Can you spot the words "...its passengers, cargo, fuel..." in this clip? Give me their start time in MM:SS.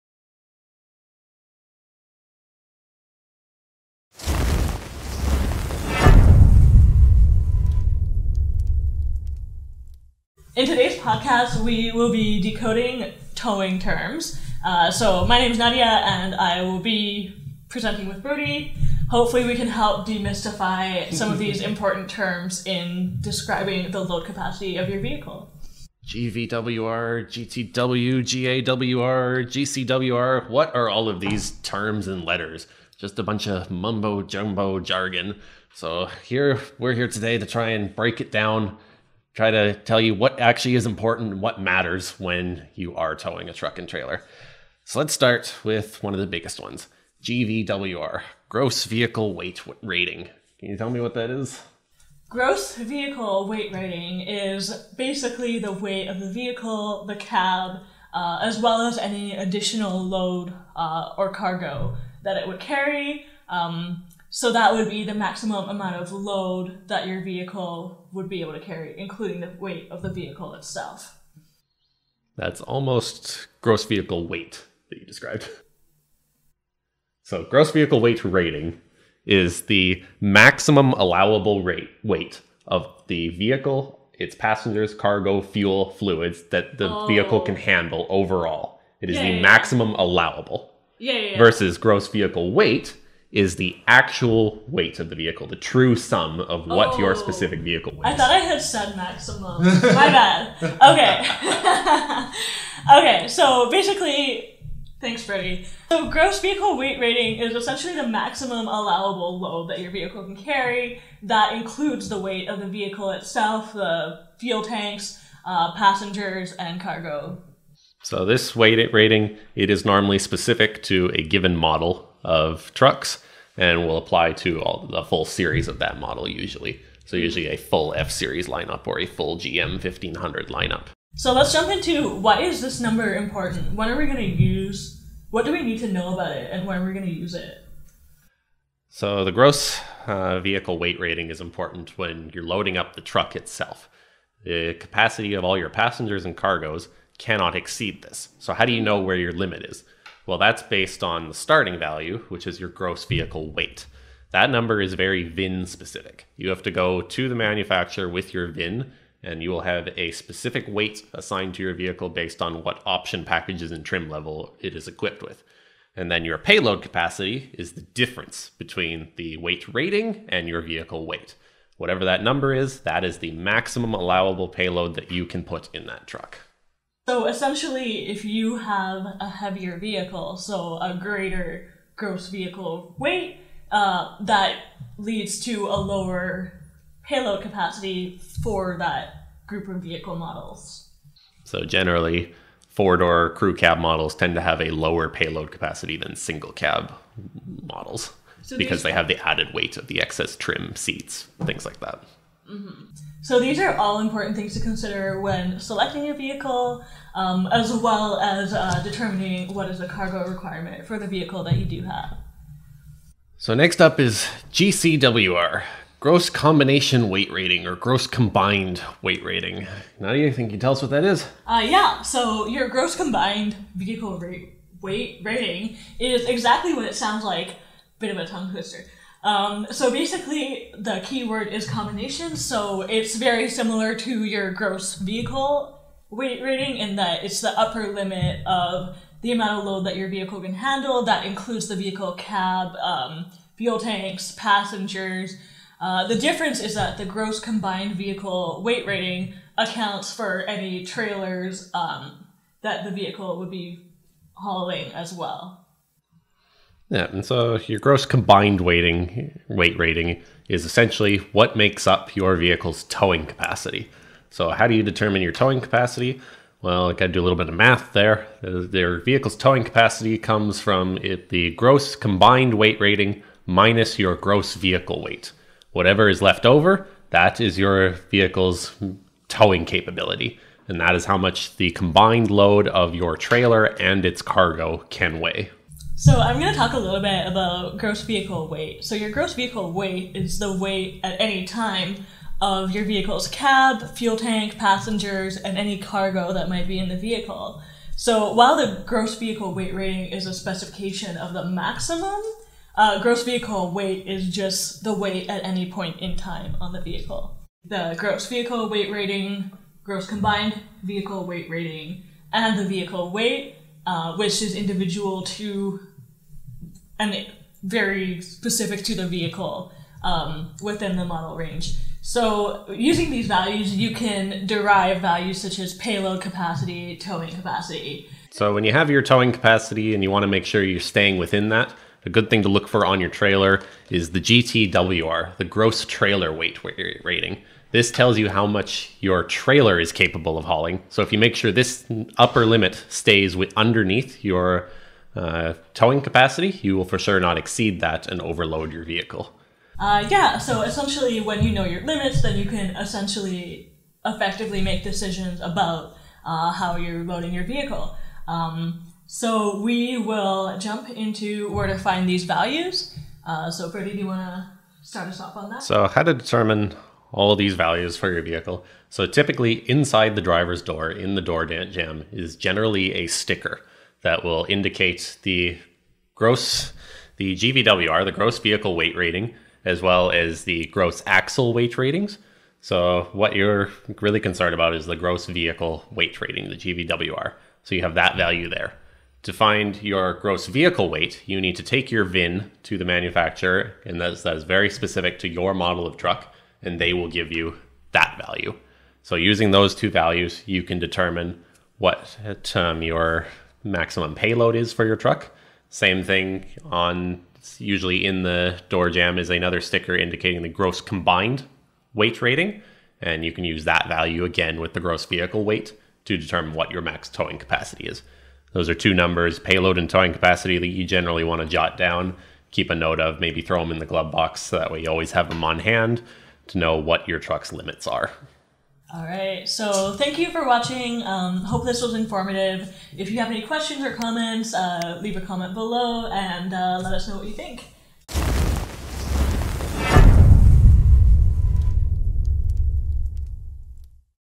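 01:24.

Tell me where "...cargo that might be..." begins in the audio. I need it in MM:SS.
04:55.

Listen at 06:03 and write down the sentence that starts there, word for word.
Uh, so, Freddie, do you want to start us off on that?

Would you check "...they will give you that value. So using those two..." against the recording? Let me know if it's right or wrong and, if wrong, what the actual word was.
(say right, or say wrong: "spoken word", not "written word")
right.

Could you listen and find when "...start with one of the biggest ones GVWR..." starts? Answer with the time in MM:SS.
00:45.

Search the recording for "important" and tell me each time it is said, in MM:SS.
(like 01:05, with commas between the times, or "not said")
00:21, 00:40, 02:13, 02:21, 03:23.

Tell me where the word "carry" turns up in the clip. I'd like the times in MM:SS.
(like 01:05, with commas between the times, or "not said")
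01:02, 01:08, 01:50.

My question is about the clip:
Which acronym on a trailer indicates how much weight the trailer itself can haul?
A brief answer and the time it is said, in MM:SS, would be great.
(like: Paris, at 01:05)
GTWR, at 05:34.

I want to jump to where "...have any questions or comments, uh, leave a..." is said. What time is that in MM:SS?
07:13.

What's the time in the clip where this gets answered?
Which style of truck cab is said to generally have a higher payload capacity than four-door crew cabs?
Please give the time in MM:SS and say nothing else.
03:16.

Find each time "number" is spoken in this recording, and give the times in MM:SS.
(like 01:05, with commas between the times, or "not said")
02:12, 02:34, 02:52, 06:58.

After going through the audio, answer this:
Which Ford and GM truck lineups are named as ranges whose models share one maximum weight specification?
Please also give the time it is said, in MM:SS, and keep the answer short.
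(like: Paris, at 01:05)
F series, GM 1500, at 02:07.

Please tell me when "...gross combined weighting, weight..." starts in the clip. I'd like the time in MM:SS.
04:17.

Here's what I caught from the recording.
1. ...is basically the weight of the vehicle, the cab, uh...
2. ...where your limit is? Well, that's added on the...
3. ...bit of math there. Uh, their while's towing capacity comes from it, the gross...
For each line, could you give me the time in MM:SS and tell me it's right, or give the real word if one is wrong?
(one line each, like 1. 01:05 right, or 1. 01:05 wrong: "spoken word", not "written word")
1. 00:54 right
2. 02:29 wrong: "based", not "added"
3. 04:27 wrong: "vehicle", not "while".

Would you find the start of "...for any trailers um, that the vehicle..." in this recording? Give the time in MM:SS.
04:10.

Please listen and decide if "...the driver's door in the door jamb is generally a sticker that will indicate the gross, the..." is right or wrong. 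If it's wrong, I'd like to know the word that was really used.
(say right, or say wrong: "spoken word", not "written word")
right.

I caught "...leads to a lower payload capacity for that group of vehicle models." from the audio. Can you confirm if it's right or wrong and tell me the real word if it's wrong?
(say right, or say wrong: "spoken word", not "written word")
right.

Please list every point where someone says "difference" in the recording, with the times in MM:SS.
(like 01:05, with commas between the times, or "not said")
02:47, 04:06.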